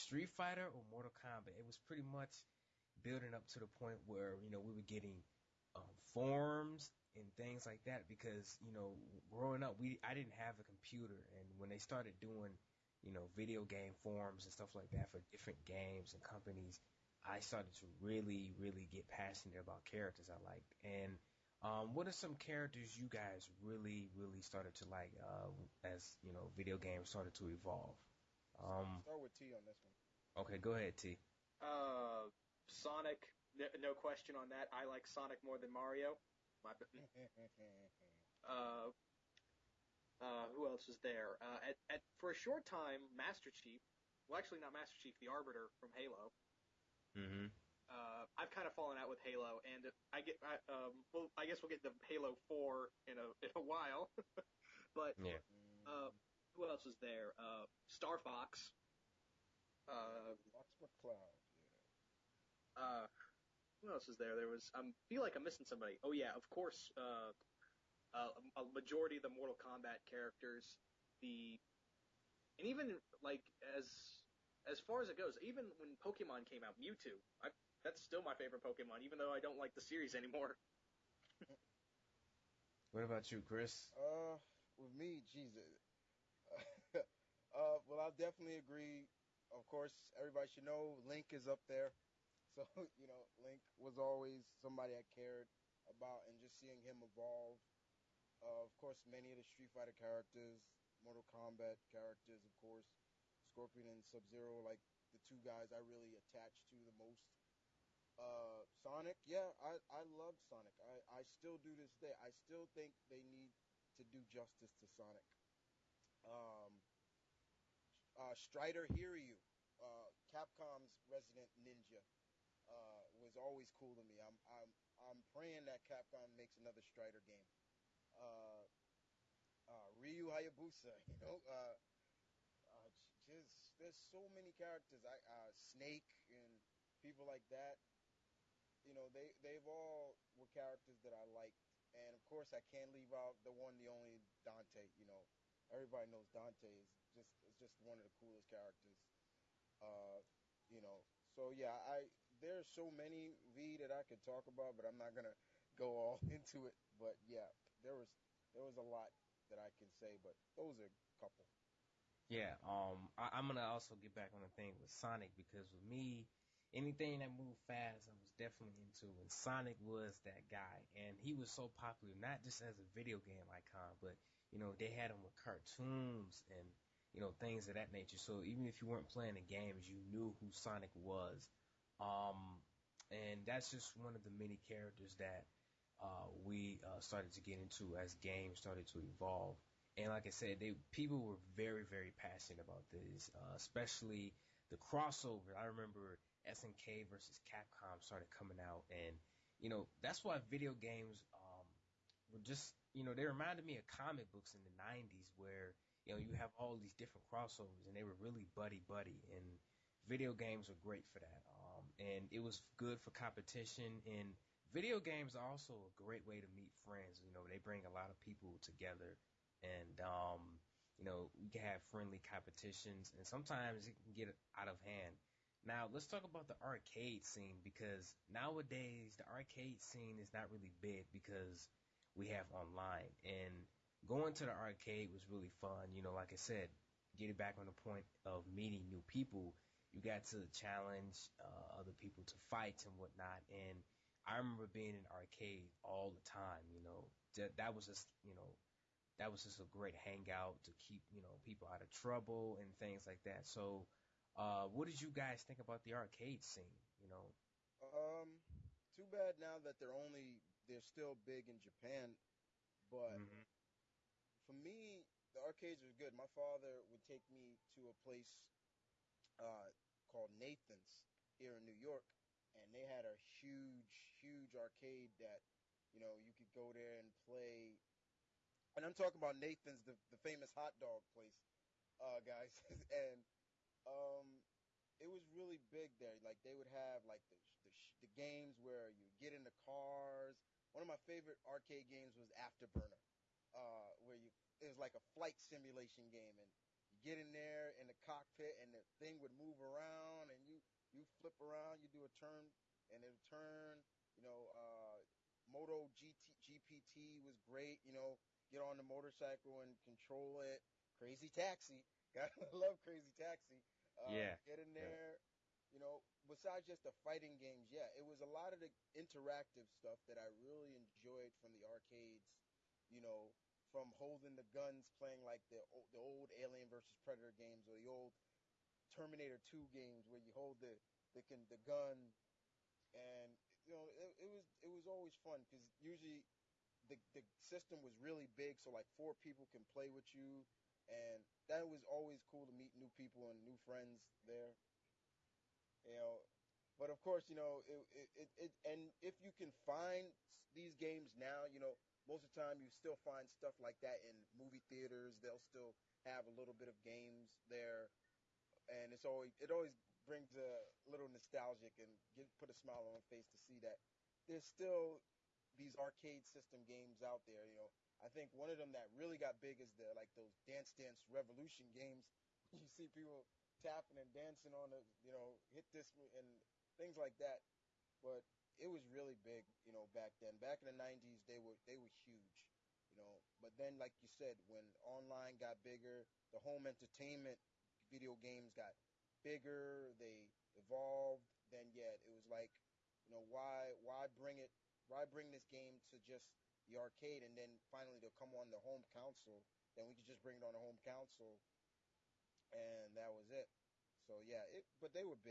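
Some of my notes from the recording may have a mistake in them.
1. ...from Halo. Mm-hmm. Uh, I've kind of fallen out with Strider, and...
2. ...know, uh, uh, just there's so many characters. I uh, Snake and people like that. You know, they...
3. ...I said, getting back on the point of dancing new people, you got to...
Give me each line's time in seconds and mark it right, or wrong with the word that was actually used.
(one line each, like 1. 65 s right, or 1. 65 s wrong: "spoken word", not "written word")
1. 45 s wrong: "Halo", not "Strider"
2. 131 s right
3. 236 s wrong: "meeting", not "dancing".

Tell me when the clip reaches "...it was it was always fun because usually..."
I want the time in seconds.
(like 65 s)
334 s.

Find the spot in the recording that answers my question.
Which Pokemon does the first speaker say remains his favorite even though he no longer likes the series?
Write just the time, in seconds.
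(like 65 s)
76 s.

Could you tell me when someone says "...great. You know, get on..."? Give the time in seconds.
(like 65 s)
307 s.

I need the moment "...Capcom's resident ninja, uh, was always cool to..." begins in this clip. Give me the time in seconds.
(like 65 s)
120 s.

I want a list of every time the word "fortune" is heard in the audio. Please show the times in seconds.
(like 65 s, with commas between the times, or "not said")
not said.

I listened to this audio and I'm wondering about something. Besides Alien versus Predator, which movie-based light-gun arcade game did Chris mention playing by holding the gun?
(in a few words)
Terminator 2.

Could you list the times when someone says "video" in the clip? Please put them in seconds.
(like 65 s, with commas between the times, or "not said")
13 s, 26 s, 172 s, 200 s, 210 s, 214 s, 387 s.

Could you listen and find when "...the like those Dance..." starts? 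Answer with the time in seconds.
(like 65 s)
369 s.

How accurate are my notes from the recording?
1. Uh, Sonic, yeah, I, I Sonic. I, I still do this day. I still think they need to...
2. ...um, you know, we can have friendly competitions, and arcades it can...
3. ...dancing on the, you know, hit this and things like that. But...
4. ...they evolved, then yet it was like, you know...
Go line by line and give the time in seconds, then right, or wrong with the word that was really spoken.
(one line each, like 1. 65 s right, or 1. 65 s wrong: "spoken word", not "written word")
1. 108 s right
2. 220 s wrong: "sometimes", not "arcades"
3. 374 s right
4. 389 s right.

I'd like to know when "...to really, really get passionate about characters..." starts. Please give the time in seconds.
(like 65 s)
17 s.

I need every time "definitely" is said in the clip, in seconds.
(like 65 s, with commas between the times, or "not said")
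88 s, 168 s.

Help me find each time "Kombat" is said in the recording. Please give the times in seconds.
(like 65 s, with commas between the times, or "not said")
1 s, 69 s, 101 s.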